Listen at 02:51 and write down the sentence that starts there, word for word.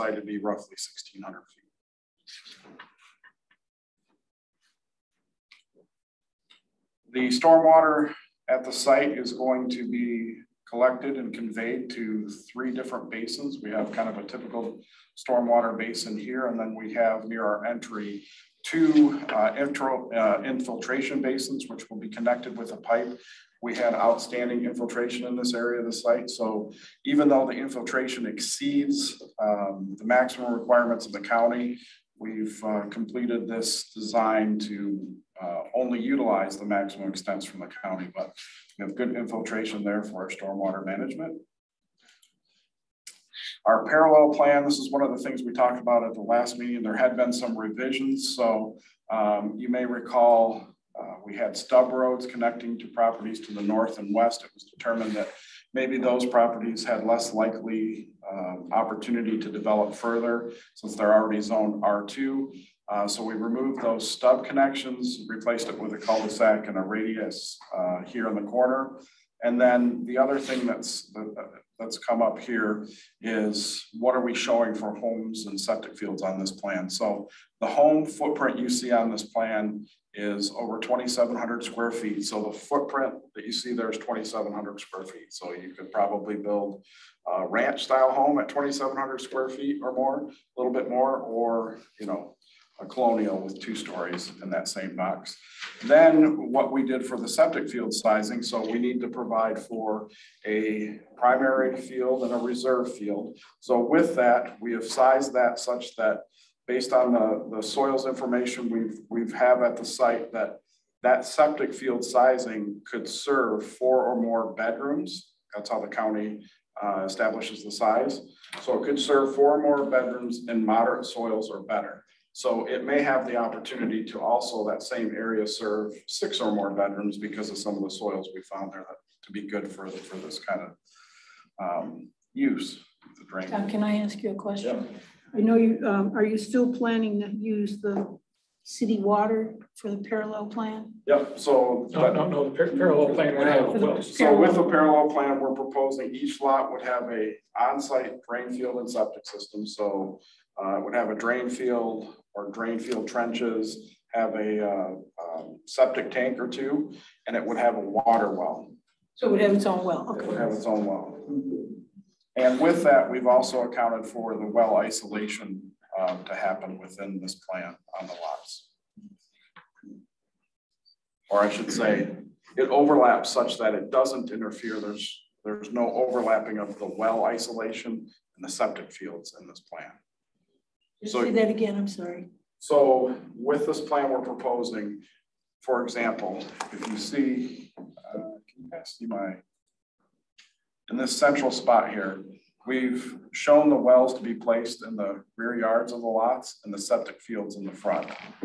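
Or I should say, it overlaps such that it doesn't interfere.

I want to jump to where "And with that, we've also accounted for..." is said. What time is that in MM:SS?
02:42.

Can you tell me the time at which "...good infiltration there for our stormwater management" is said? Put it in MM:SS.
00:38.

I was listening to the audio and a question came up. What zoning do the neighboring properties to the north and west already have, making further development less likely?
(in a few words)
R2.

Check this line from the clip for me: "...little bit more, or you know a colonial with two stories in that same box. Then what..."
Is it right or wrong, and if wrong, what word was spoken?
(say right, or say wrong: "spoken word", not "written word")
right.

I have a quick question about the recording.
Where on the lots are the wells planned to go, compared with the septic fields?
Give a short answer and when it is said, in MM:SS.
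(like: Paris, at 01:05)
rear yards, at 03:15.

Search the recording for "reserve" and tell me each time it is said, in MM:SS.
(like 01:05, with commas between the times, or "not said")
01:42.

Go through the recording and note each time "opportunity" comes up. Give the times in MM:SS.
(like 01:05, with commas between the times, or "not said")
00:58, 02:03.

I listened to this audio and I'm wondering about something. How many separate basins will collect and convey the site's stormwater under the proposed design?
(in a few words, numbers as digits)
3.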